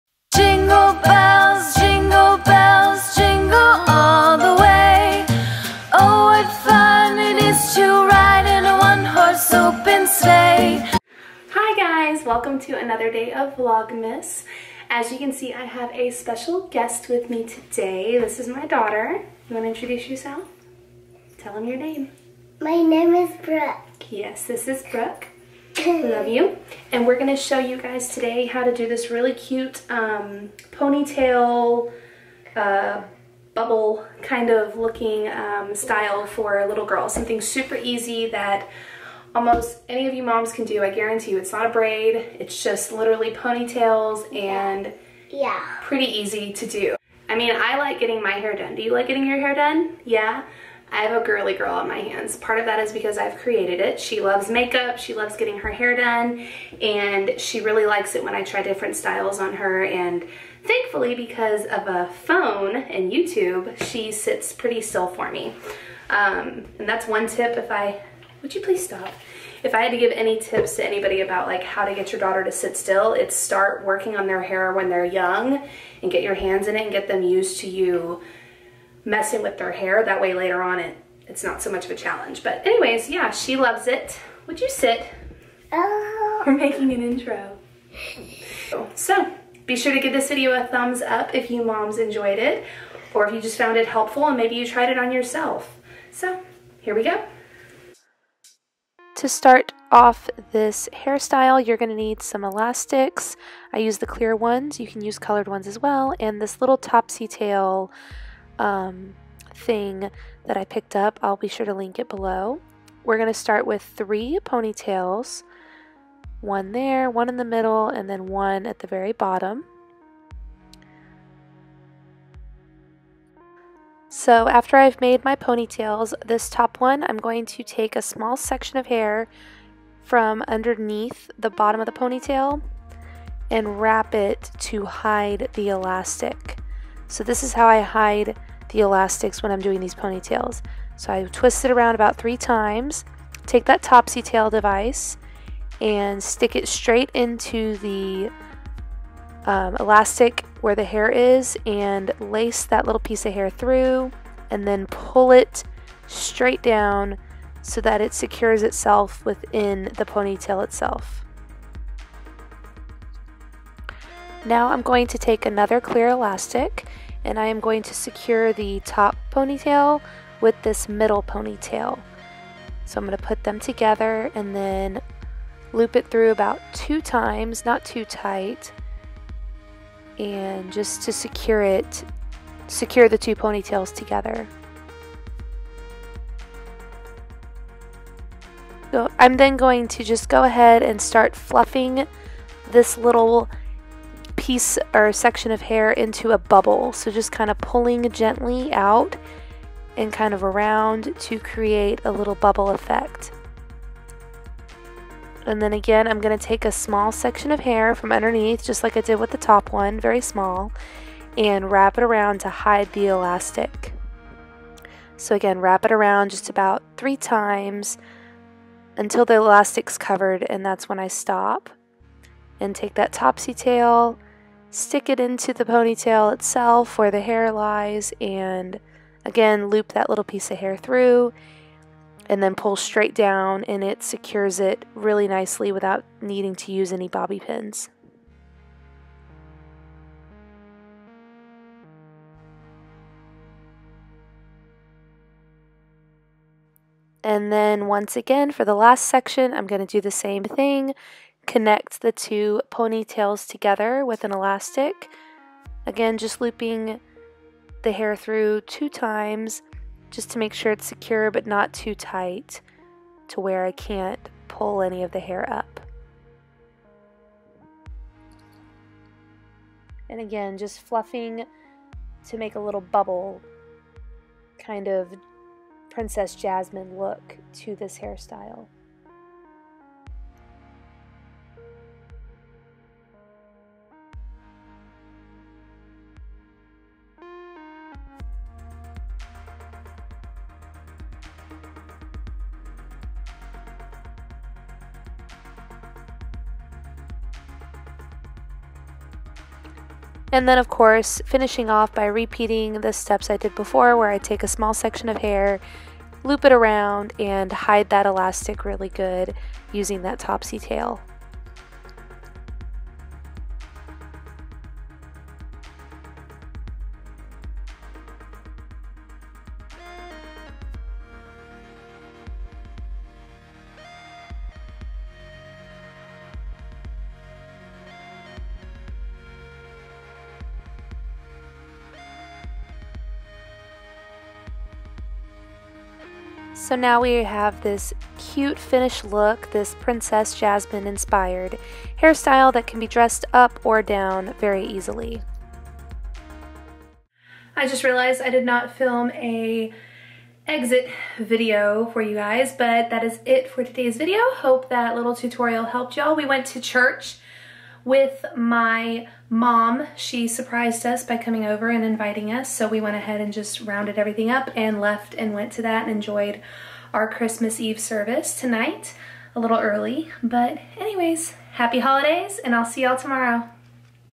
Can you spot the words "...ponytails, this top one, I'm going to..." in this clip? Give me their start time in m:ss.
2:05.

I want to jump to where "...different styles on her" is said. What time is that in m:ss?
0:58.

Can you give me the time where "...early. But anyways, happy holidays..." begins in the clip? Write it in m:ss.
6:09.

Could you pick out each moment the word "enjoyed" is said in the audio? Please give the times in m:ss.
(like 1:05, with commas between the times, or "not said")
1:31, 6:05.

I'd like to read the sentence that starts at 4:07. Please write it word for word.
And then once again, for the last section, I'm going to do the same thing.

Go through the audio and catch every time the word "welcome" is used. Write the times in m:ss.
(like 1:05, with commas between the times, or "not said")
0:12.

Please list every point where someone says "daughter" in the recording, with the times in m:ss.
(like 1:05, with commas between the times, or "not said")
0:18, 1:12.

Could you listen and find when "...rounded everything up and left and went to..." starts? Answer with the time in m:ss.
6:03.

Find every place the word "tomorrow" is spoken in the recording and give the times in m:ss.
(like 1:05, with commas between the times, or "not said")
6:12.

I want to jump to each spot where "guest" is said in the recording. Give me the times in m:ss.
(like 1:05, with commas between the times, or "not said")
0:16.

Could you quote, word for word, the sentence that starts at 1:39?
To start off this hairstyle, you're going to need some elastics.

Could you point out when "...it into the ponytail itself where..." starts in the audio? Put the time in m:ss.
3:45.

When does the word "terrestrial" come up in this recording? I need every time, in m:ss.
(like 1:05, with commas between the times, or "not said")
not said.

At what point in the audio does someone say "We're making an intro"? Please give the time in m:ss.
1:26.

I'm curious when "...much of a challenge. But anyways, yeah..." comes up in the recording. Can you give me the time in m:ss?
1:21.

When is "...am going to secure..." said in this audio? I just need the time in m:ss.
2:47.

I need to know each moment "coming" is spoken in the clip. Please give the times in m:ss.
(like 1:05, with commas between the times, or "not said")
6:01.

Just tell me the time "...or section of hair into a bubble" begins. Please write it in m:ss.
3:14.